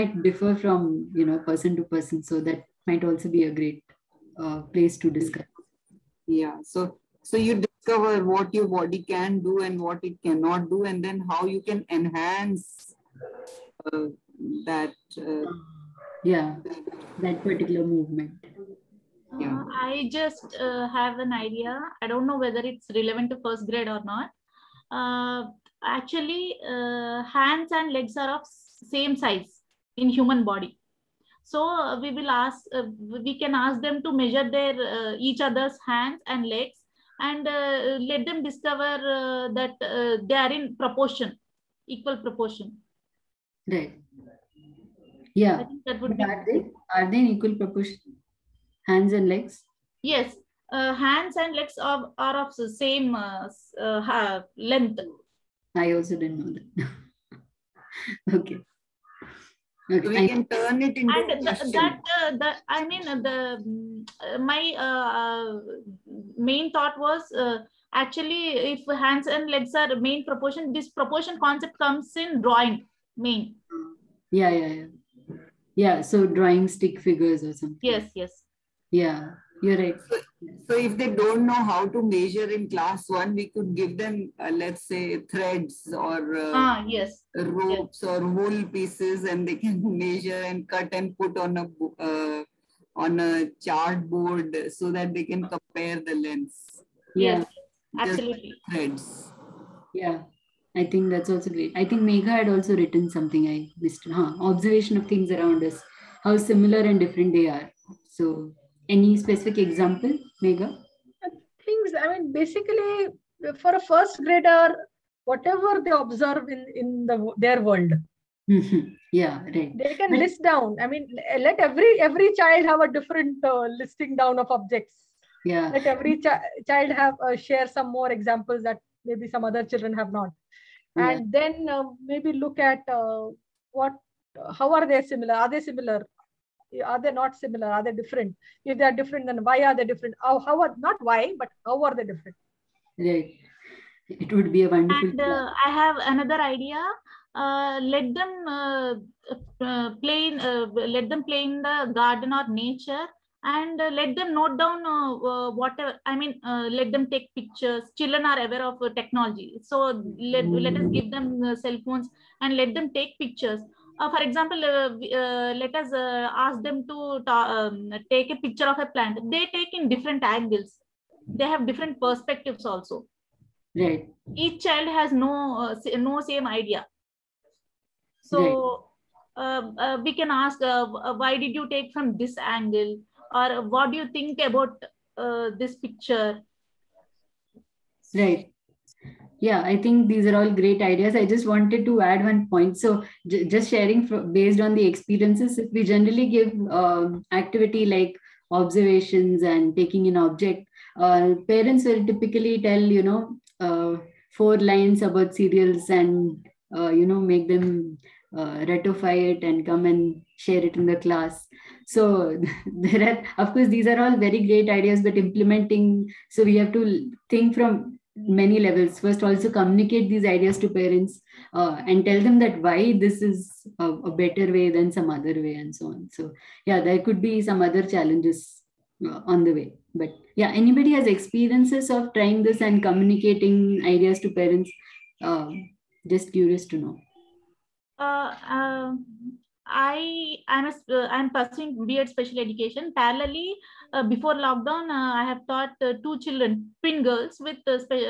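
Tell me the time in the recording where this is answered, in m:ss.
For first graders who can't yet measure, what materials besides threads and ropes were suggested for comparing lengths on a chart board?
1:28.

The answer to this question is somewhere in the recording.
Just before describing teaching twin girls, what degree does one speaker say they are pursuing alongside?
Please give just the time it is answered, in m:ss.
4:01.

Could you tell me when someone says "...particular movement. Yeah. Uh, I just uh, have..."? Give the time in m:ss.
0:17.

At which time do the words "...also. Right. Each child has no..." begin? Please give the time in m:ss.
2:52.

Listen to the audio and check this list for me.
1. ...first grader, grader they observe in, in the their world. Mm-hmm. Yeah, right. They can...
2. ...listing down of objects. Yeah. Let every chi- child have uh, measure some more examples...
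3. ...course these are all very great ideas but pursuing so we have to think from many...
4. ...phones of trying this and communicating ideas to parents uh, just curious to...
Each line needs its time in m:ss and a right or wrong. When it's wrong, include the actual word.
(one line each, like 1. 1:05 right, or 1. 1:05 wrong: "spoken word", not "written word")
1. 1:53 wrong: "whatever", not "grader"
2. 2:03 wrong: "share", not "measure"
3. 3:33 wrong: "implementing", not "pursuing"
4. 3:51 wrong: "experiences", not "phones".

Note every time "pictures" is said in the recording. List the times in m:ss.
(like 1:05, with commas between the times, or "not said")
2:37, 2:43, 2:48, 3:05.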